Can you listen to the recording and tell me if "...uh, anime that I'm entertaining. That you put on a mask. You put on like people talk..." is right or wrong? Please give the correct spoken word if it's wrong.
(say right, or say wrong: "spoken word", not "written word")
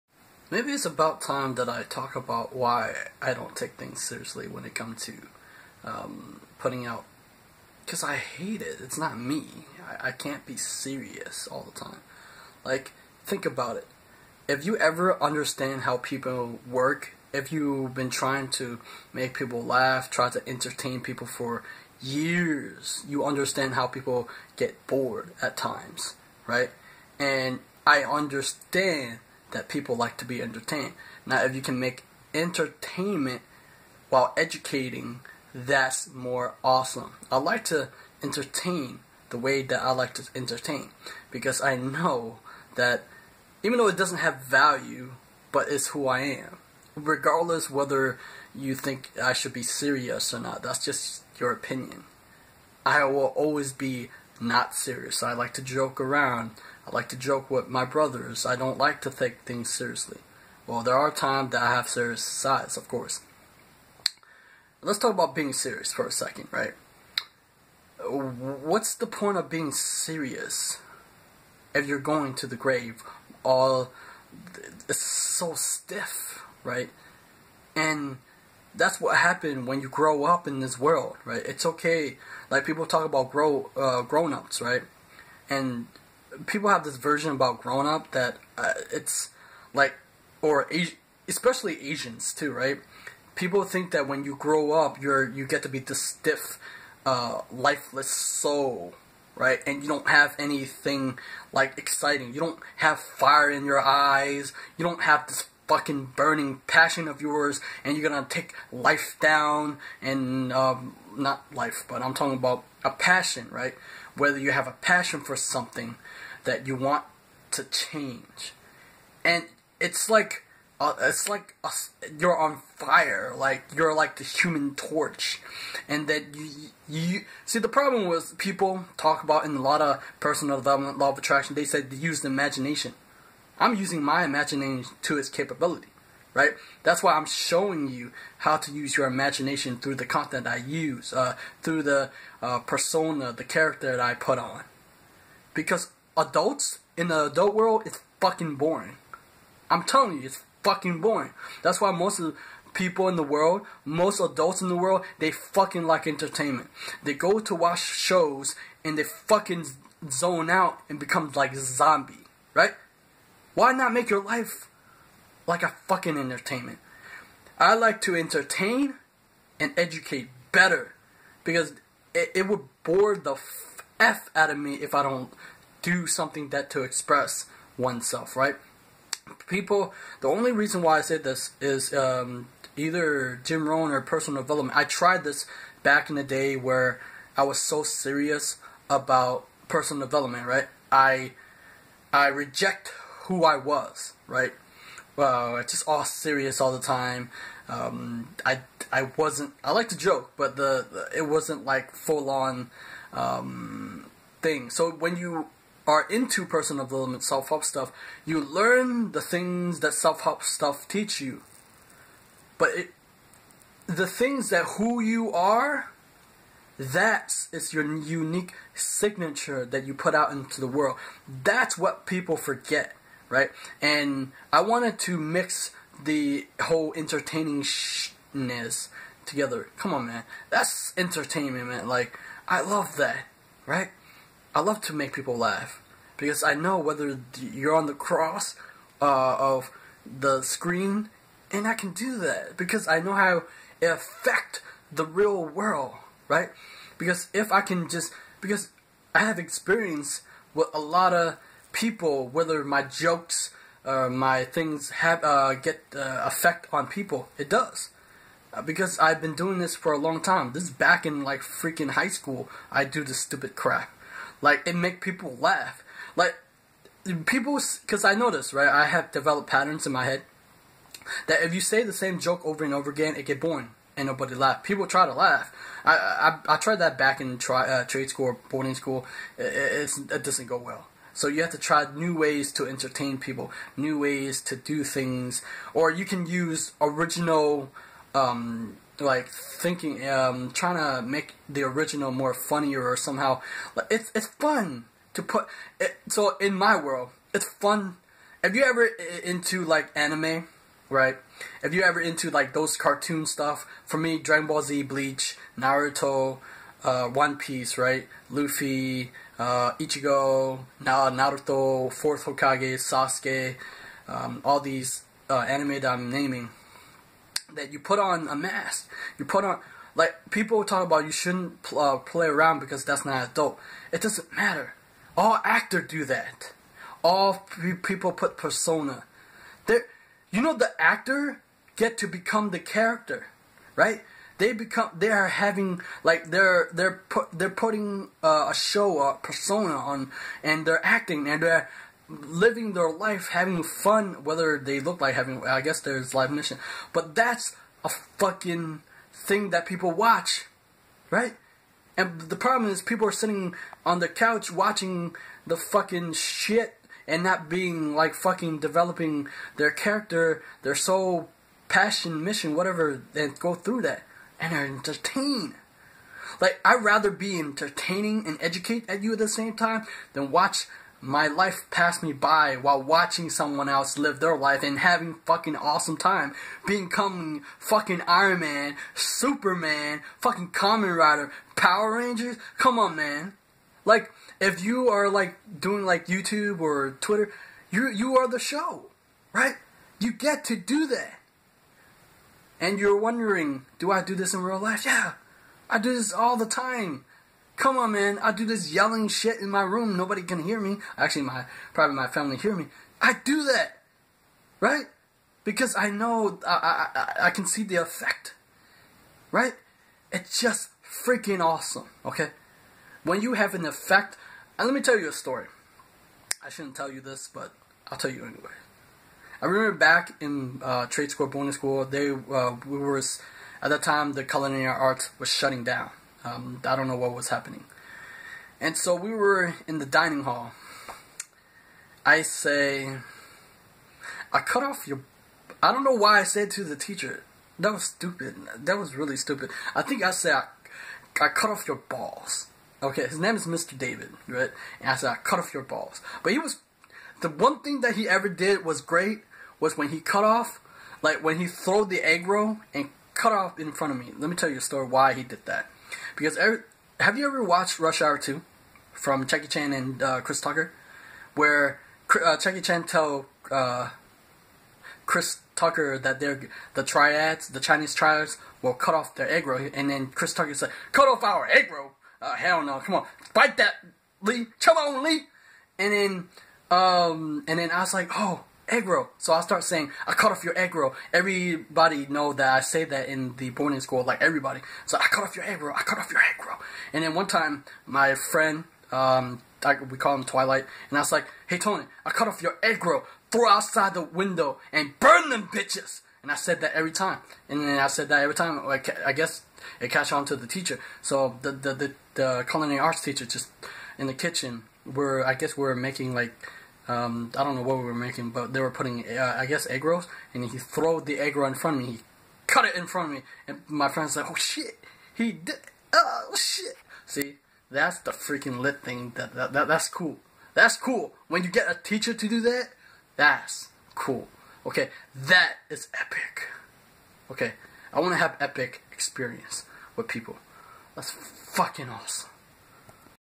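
wrong: "naming", not "entertaining".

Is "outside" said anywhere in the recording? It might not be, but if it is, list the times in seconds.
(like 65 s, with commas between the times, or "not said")
493 s.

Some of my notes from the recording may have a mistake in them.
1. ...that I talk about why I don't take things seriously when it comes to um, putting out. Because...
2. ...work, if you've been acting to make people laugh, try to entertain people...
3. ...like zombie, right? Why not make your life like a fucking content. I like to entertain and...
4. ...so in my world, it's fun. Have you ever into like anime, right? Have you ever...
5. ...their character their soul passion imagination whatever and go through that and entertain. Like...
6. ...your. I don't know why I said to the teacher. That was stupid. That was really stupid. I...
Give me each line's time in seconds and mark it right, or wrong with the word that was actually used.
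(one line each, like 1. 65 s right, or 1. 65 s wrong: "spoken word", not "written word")
1. 1 s right
2. 16 s wrong: "trying", not "acting"
3. 161 s wrong: "entertainment", not "content"
4. 296 s right
5. 359 s wrong: "mission", not "imagination"
6. 434 s right.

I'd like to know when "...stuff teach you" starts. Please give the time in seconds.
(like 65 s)
210 s.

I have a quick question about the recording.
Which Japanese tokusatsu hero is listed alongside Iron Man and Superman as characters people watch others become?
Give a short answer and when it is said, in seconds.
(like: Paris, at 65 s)
Kamen Rider, at 380 s.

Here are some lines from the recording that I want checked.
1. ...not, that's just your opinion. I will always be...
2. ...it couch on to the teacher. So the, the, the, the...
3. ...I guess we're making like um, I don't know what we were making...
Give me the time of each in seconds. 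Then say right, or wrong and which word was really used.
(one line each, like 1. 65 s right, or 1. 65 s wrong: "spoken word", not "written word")
1. 50 s right
2. 499 s wrong: "catch", not "couch"
3. 505 s right.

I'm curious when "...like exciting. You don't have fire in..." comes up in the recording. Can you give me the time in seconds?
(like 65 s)
101 s.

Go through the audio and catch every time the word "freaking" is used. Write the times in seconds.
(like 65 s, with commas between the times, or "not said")
261 s, 411 s, 518 s.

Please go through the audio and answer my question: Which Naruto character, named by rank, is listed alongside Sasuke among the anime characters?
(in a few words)
Fourth Hokage.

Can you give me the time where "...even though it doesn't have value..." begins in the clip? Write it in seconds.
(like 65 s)
43 s.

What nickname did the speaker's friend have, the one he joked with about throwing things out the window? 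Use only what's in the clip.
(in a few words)
Twilight.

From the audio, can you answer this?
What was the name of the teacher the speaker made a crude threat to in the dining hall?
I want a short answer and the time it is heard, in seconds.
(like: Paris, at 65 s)
Mr. David, at 443 s.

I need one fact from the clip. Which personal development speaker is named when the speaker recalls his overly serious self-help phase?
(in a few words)
Jim Rohn.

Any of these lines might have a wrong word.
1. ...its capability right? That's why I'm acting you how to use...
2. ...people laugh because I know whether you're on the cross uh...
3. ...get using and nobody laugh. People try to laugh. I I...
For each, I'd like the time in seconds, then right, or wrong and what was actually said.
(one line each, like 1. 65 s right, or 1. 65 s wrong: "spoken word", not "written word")
1. 135 s wrong: "showing", not "acting"
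2. 235 s right
3. 273 s wrong: "boring", not "using".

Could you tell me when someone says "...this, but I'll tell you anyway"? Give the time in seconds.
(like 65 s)
417 s.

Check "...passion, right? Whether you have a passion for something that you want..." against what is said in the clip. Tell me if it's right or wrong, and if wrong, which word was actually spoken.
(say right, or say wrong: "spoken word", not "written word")
right.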